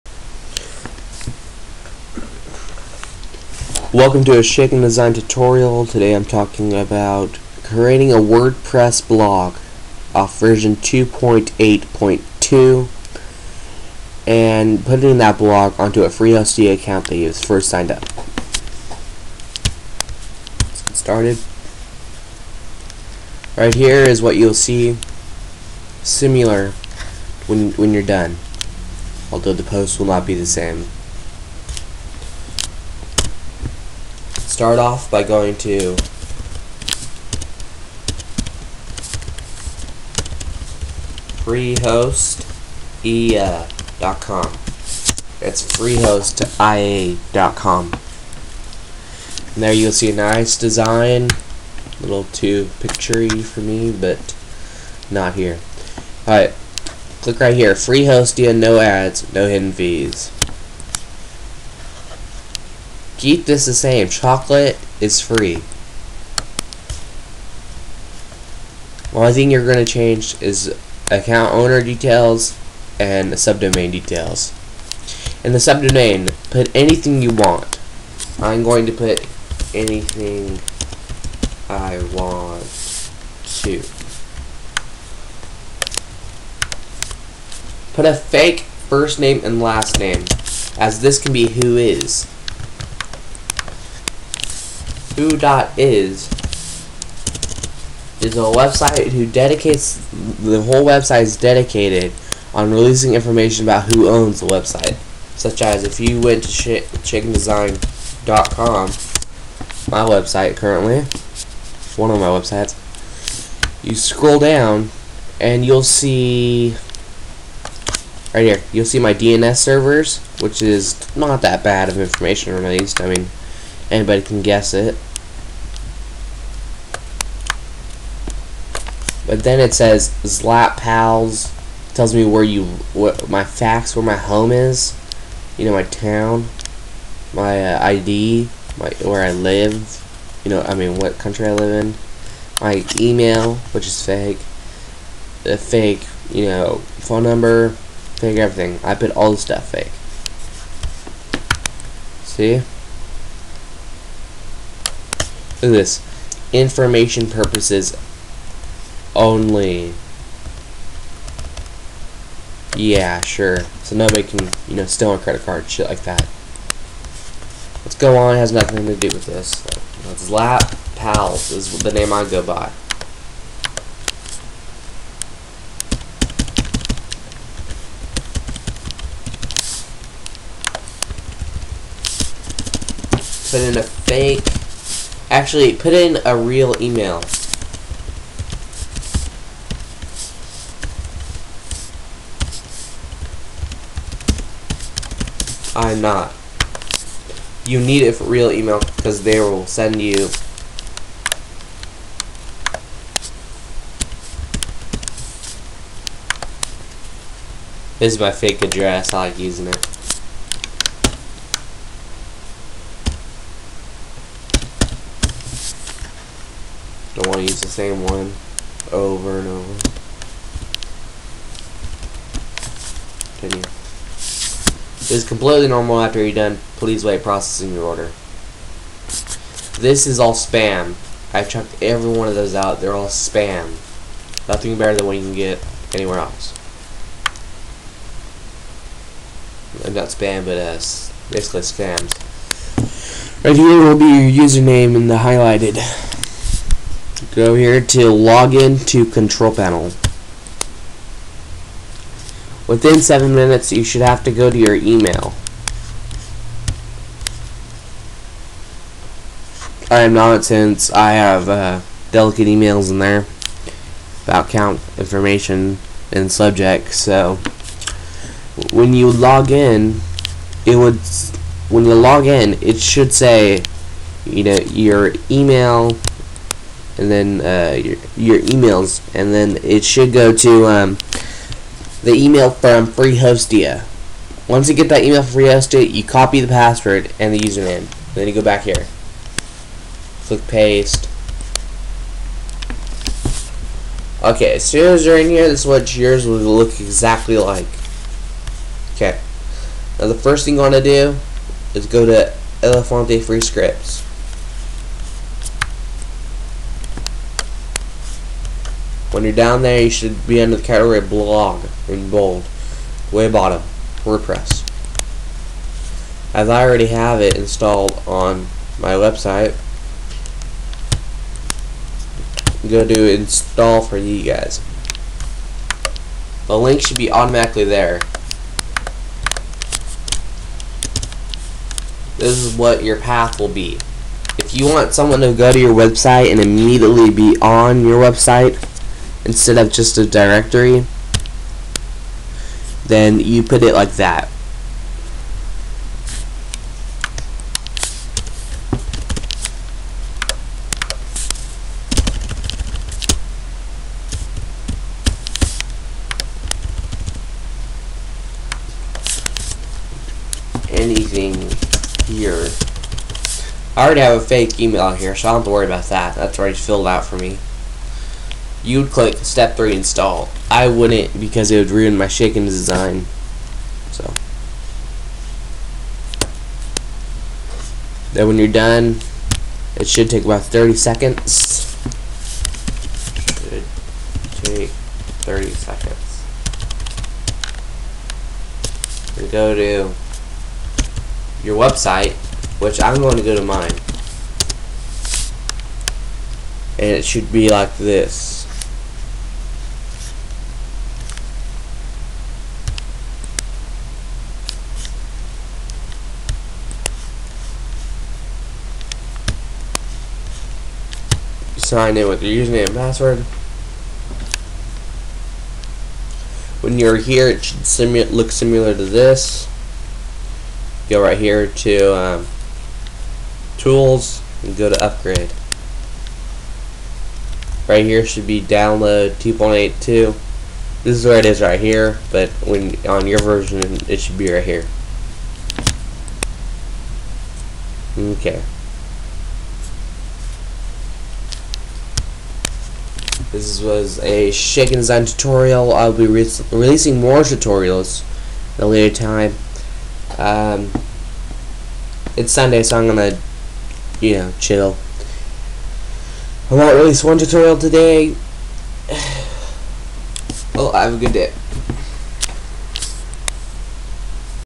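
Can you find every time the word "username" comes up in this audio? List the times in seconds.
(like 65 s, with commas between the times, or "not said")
244 s, 287 s, 412 s.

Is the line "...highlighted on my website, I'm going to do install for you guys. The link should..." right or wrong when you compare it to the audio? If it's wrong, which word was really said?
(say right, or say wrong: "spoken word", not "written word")
wrong: "installed", not "highlighted".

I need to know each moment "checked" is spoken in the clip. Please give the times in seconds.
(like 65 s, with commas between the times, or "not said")
231 s.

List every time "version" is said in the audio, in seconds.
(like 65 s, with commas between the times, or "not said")
10 s, 433 s.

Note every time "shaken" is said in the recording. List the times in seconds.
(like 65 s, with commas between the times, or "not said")
4 s, 372 s, 444 s.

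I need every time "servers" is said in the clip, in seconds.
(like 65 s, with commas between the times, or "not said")
119 s.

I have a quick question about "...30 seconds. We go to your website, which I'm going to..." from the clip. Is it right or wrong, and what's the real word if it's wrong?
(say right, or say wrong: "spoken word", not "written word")
right.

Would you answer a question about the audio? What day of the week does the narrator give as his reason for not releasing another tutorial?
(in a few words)
Sunday.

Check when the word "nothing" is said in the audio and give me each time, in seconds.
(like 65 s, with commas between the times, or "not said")
168 s, 234 s.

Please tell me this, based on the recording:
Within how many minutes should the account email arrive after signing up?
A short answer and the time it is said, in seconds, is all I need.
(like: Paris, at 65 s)
7, at 253 s.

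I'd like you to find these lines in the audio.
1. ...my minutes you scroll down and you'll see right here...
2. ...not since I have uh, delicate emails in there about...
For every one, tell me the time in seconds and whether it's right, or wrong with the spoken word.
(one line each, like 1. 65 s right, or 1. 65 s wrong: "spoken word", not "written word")
1. 112 s wrong: "websites", not "minutes"
2. 260 s right.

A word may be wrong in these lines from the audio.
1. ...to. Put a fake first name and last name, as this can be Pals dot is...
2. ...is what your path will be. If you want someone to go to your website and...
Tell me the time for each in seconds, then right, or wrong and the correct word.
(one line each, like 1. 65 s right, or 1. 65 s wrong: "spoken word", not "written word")
1. 83 s wrong: "WHOIS", not "Pals"
2. 332 s right.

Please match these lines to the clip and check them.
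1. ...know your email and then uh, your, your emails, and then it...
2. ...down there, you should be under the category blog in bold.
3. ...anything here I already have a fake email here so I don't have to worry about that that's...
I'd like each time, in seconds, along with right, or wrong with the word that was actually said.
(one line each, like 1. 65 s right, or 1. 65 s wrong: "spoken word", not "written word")
1. 274 s right
2. 309 s right
3. 360 s right.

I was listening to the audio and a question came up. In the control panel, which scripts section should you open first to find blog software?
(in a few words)
Elefante Free Scripts.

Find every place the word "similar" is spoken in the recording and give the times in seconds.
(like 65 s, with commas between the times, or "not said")
26 s, 418 s.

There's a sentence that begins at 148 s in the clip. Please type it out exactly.
I put all the stuff fake.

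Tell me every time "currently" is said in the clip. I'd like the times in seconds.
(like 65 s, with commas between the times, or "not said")
110 s.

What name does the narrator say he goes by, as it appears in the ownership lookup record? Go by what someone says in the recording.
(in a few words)
Zlat Pals.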